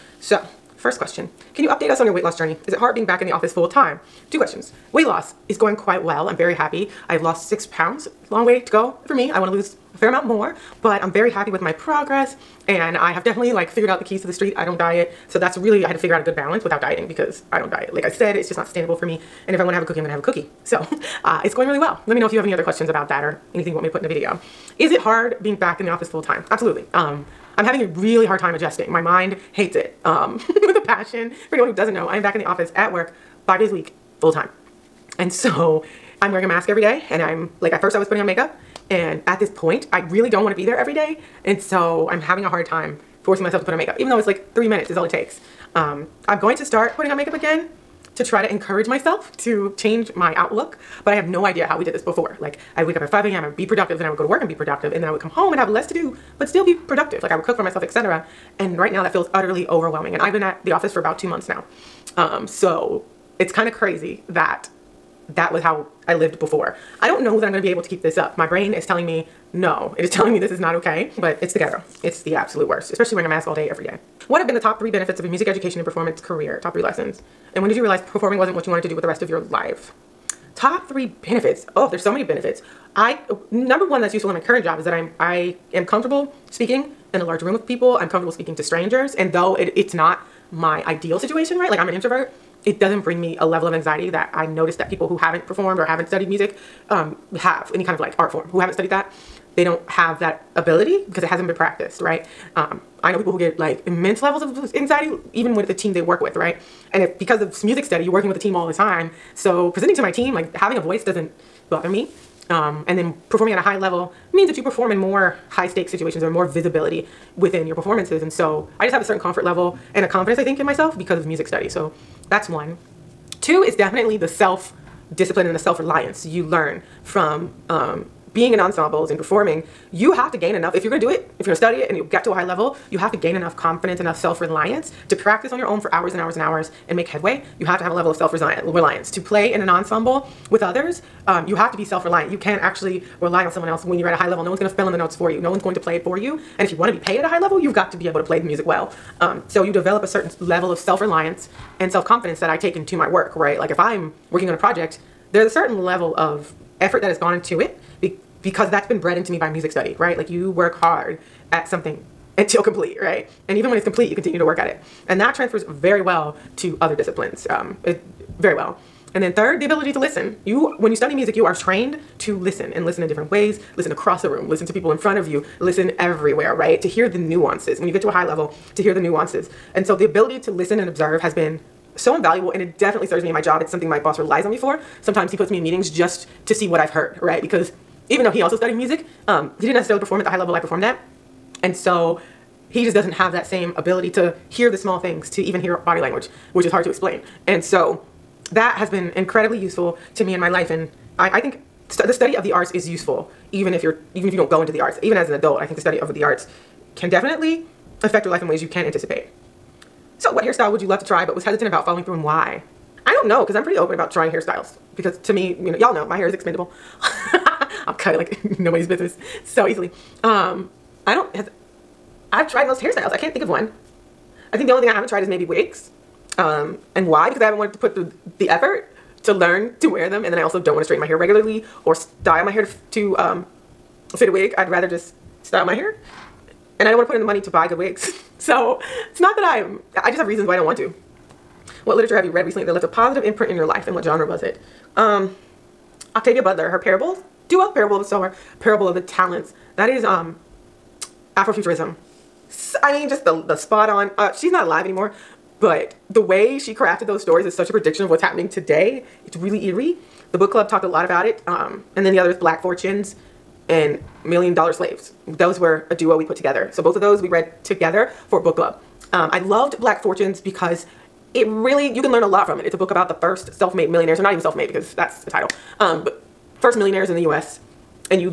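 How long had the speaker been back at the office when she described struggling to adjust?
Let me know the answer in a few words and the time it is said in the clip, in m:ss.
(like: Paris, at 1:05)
about two months, at 1:00.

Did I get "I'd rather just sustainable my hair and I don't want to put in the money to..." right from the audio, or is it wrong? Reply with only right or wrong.
wrong.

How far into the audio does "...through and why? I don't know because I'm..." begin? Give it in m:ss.
3:32.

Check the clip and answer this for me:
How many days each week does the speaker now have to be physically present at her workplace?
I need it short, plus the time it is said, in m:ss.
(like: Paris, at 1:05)
5, at 0:33.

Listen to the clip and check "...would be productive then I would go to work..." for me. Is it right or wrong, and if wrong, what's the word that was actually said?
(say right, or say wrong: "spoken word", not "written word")
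right.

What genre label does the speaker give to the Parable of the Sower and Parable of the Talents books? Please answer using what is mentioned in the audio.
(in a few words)
Afrofuturism.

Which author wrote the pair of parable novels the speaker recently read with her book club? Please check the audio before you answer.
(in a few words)
Octavia Butler.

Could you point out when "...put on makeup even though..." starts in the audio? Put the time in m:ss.
0:43.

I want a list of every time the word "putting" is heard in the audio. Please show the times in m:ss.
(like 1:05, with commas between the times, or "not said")
0:38, 0:46.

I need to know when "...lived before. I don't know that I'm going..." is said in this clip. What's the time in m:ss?
1:06.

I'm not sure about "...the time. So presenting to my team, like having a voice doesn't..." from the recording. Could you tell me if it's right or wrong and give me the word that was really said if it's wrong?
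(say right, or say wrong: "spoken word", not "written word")
right.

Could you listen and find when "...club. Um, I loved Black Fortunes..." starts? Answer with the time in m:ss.
4:28.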